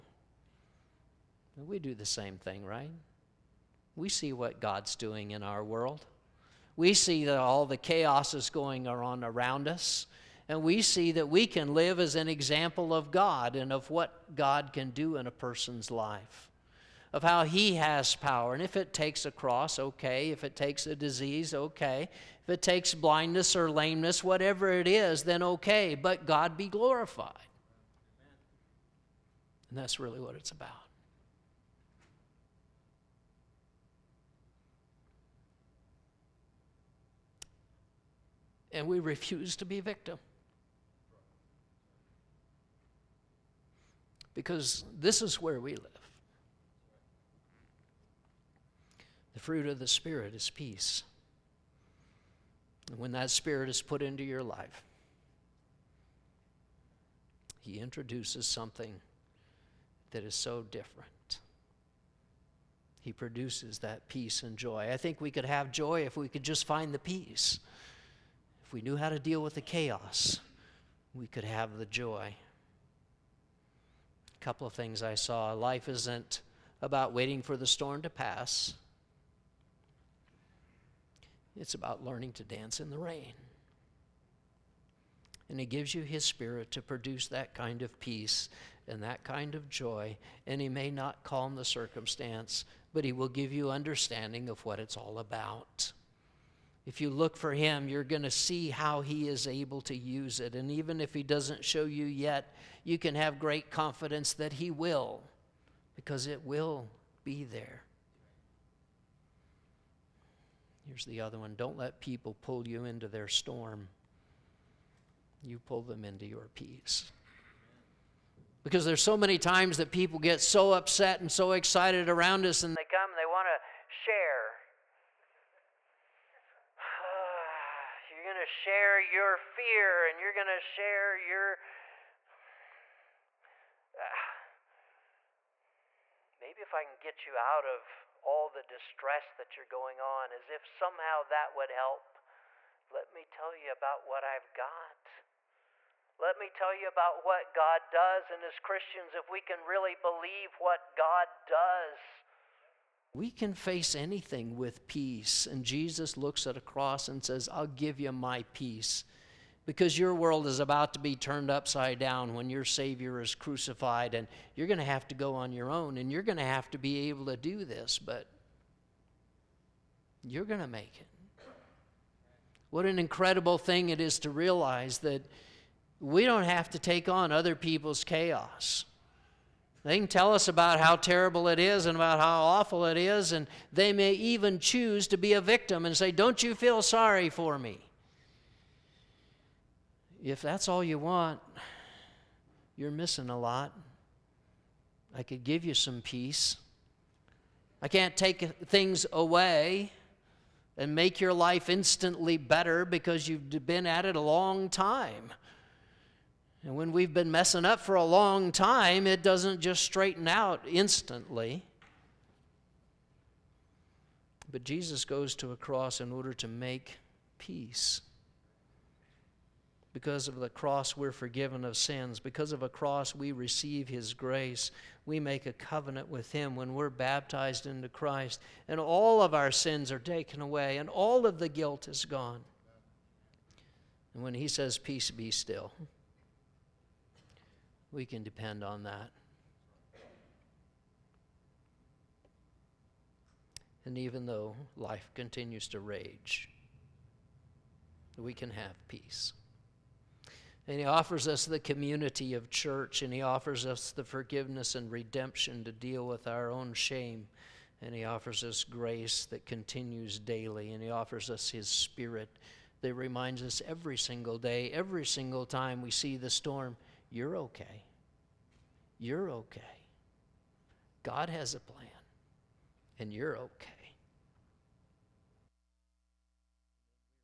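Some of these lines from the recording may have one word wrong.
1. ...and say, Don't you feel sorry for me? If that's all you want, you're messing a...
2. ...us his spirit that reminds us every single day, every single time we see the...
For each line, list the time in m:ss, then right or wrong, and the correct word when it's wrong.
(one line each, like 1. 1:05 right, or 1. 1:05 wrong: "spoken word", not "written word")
1. 3:05 wrong: "missing", not "messing"
2. 4:21 right.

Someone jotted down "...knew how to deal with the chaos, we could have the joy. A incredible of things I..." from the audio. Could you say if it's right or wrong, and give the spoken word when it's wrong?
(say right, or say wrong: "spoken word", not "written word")
wrong: "couple", not "incredible".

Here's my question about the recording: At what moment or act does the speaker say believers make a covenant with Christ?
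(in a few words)
baptized.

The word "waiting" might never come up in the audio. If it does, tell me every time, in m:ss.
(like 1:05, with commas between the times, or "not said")
1:17.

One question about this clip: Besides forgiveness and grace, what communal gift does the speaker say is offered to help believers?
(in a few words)
community of church.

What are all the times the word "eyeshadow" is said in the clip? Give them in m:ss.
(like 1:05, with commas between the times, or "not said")
not said.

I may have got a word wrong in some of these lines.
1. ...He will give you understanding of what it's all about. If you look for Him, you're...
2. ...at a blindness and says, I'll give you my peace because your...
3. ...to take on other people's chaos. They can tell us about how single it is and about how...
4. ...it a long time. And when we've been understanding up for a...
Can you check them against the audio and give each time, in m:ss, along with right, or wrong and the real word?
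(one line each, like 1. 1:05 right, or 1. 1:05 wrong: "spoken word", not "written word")
1. 1:33 right
2. 2:36 wrong: "cross", not "blindness"
3. 2:56 wrong: "terrible", not "single"
4. 3:24 wrong: "messing", not "understanding".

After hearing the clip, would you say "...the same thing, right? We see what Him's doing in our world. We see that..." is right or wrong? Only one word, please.
wrong.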